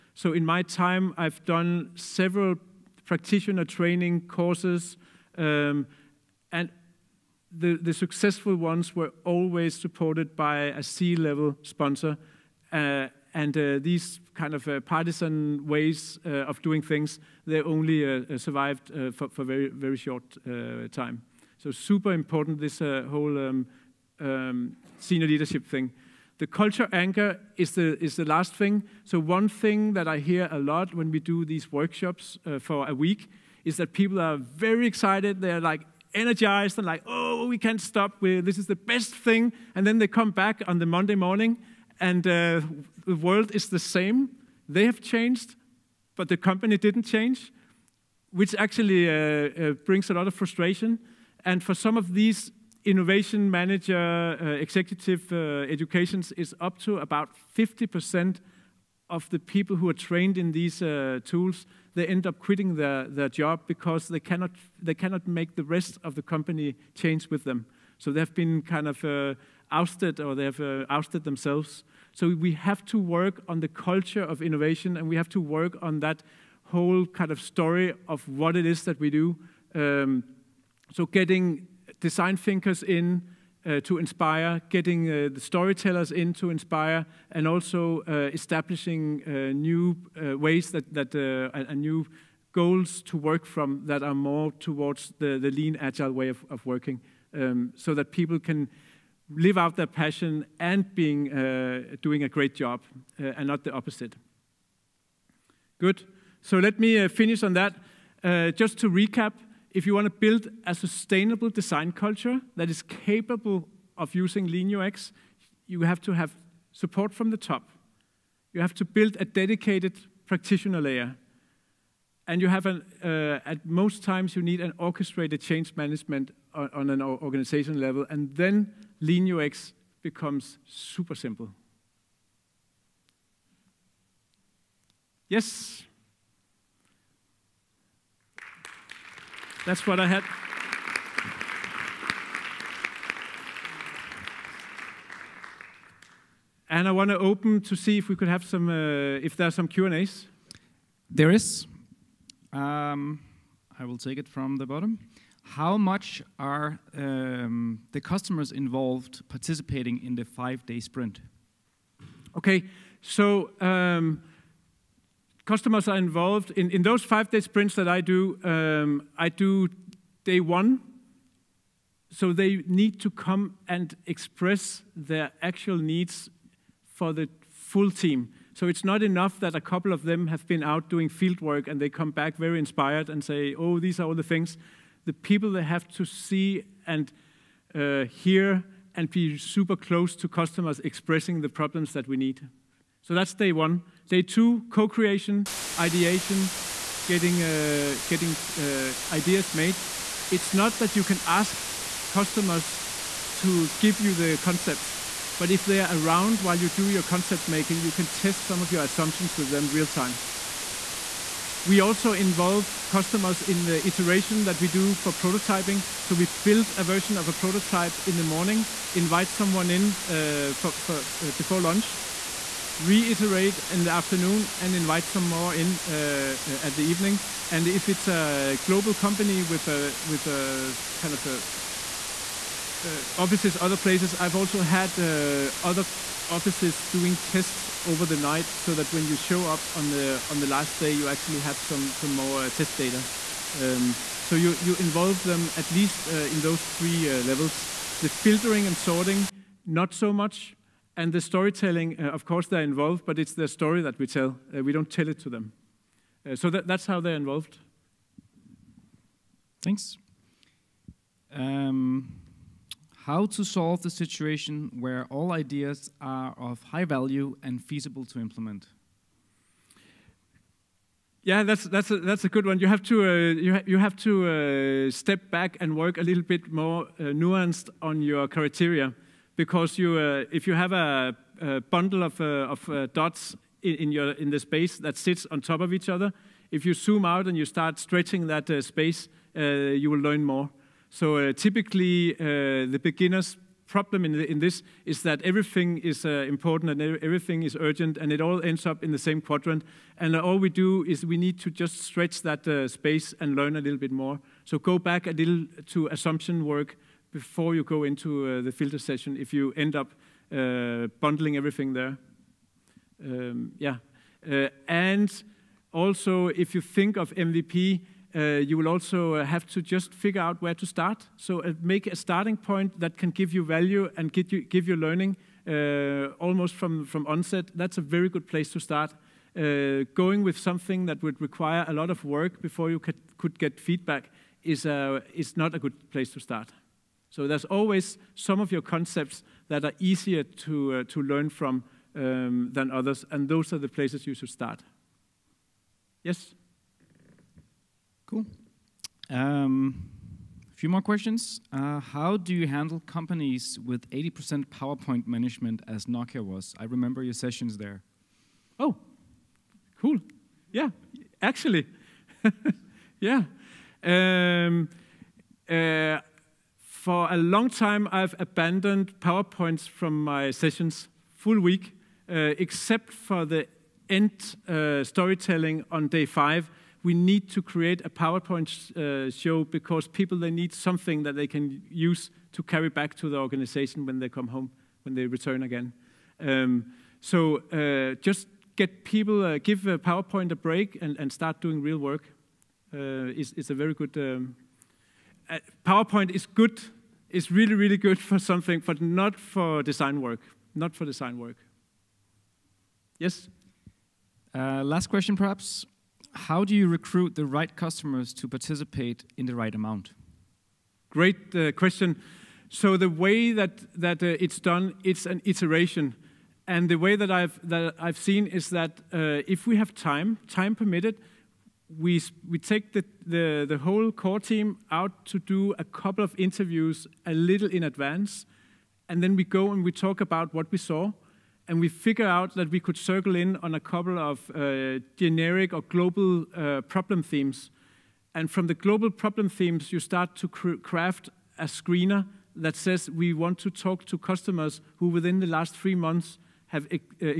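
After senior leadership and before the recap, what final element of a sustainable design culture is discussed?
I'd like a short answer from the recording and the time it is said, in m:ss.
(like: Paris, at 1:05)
Culture anchor, at 0:26.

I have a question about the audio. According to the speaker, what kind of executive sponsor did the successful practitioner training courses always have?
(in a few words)
C-level sponsor.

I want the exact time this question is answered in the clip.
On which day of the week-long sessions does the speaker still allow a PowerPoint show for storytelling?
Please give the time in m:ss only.
6:15.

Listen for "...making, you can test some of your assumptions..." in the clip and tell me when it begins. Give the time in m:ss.
3:27.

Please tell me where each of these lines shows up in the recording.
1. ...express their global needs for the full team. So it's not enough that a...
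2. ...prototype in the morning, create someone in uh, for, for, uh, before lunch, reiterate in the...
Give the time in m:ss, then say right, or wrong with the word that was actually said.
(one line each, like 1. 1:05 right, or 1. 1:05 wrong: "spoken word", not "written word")
1. 2:54 wrong: "actual", not "global"
2. 3:37 wrong: "invite", not "create".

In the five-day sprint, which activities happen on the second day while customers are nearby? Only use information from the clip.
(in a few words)
Co-creation, ideation.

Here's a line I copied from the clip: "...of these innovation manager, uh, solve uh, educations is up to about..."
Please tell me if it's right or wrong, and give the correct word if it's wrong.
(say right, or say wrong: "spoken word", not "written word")
wrong: "executive", not "solve".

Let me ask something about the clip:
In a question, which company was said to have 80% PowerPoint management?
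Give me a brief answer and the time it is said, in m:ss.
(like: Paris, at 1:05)
Nokia, at 5:55.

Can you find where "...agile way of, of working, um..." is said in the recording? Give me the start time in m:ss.
1:35.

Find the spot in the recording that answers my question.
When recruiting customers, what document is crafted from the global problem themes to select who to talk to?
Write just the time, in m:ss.
7:21.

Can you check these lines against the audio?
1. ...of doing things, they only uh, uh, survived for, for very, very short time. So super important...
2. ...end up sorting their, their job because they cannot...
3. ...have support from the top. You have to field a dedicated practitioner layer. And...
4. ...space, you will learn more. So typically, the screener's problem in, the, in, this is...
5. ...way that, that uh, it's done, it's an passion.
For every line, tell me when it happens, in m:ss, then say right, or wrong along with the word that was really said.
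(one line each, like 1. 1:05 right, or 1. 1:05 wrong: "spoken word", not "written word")
1. 0:16 right
2. 1:02 wrong: "quitting", not "sorting"
3. 1:56 wrong: "build", not "field"
4. 4:48 wrong: "beginner", not "screener"
5. 6:52 wrong: "iteration", not "passion".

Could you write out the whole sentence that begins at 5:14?
Uh, and also, if you think of MVP, uh, you will also have to just figure out where to start.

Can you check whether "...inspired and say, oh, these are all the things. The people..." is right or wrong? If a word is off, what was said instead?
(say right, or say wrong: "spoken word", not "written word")
right.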